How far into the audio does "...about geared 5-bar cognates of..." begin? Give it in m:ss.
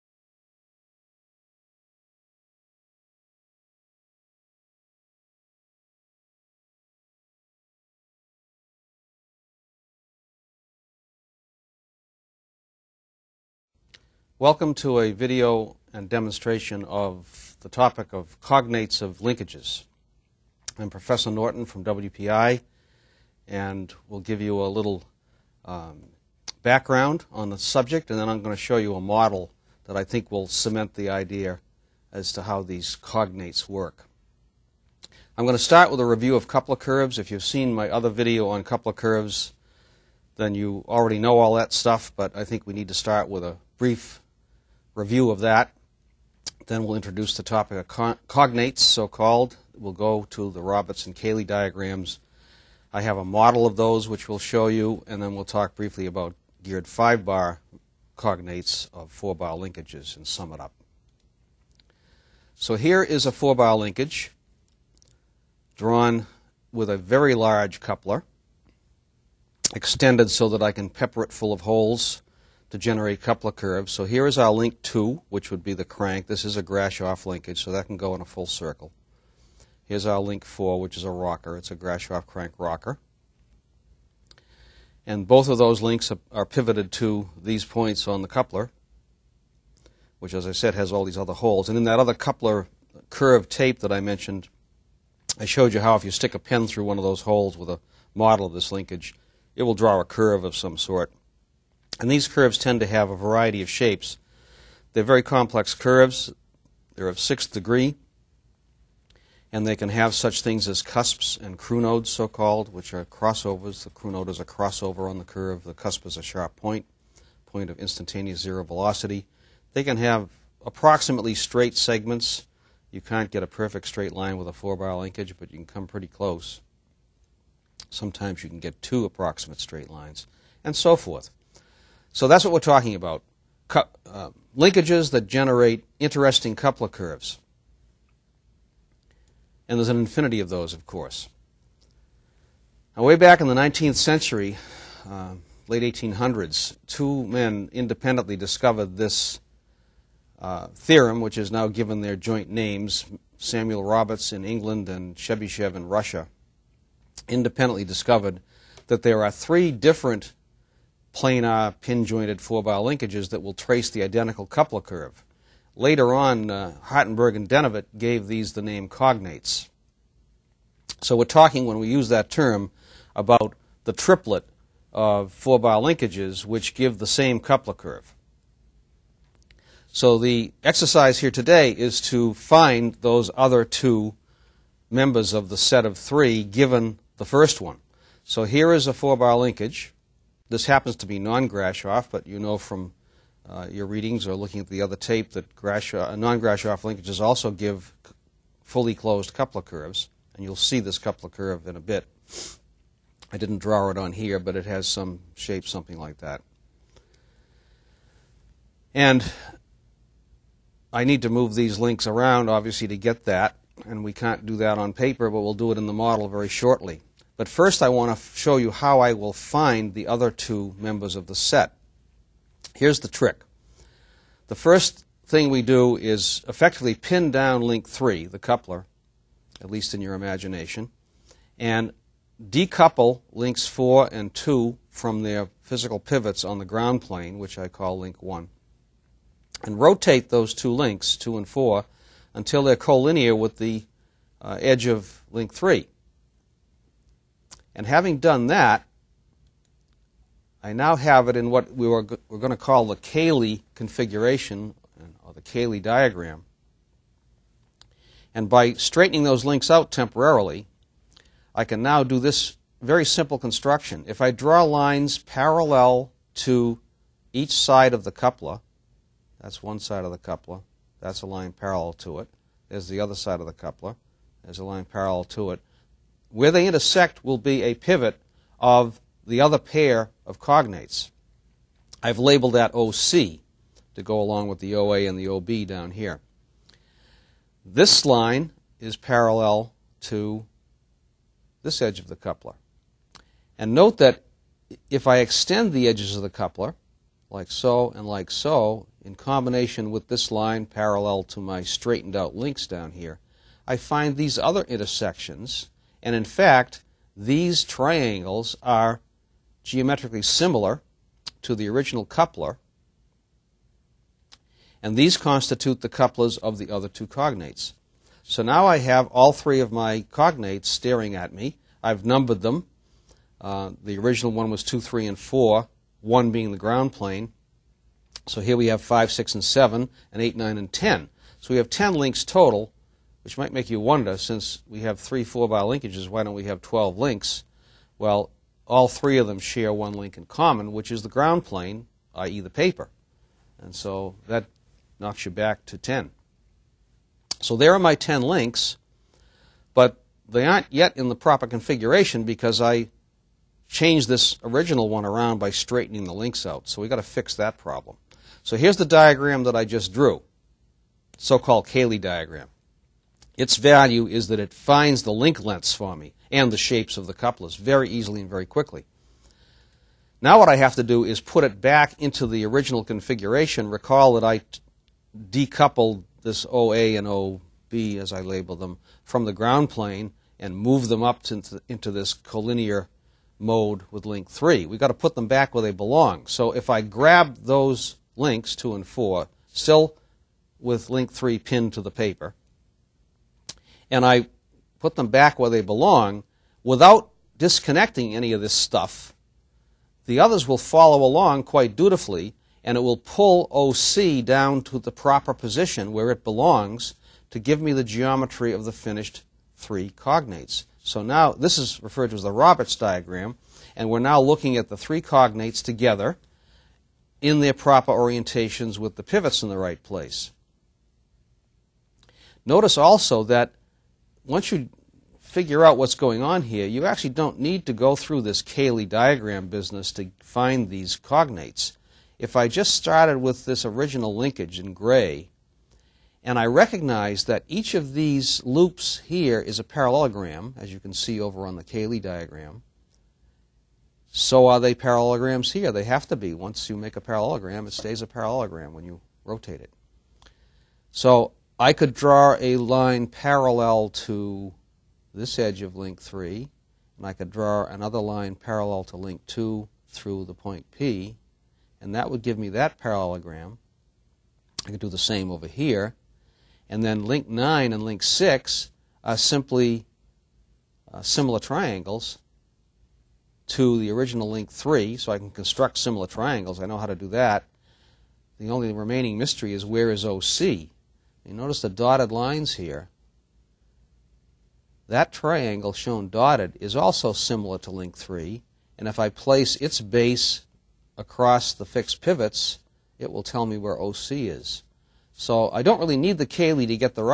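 0:56.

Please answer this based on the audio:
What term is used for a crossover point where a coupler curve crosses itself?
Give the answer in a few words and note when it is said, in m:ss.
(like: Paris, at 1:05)
Crunode, at 1:51.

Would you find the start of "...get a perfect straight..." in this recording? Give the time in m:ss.
2:03.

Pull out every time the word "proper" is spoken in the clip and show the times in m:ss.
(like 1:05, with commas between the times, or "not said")
5:51, 6:44, 6:57.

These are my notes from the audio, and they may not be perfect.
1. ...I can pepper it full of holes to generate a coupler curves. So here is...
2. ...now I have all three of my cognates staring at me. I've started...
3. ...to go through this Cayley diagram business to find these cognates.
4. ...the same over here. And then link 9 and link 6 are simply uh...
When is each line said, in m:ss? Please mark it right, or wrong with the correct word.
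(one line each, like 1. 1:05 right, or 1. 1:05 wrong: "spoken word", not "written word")
1. 1:10 right
2. 5:18 wrong: "numbered", not "started"
3. 7:07 right
4. 7:44 right.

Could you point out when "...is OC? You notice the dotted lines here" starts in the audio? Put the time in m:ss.
7:59.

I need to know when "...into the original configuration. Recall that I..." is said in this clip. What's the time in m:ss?
6:11.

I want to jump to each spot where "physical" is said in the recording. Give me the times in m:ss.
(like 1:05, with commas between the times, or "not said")
3:55.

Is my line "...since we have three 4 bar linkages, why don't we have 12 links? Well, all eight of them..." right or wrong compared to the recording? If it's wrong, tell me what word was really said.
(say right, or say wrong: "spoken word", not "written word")
wrong: "three", not "eight".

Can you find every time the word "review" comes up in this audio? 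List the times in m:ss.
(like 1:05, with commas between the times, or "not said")
0:36, 0:44.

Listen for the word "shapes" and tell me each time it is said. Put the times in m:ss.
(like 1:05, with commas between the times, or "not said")
1:43, 3:25, 6:06.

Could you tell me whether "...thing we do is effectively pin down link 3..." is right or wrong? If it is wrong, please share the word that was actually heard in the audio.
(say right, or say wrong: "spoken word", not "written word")
right.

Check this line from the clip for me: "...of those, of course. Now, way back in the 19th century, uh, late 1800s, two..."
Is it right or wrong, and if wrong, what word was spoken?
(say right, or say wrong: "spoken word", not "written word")
right.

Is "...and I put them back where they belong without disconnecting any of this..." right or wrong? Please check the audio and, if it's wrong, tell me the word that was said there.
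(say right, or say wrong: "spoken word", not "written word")
right.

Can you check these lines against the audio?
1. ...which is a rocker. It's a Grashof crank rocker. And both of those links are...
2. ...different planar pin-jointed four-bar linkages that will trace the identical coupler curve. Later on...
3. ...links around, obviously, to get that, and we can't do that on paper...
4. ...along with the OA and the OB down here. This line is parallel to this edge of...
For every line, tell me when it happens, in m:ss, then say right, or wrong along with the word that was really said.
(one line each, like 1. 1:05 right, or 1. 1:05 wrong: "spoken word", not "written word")
1. 1:20 right
2. 2:39 right
3. 3:31 right
4. 4:44 right.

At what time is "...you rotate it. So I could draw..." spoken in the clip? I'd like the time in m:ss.
7:28.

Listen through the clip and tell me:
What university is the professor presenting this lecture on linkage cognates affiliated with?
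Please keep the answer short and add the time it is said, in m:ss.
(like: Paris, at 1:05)
WPI, at 0:21.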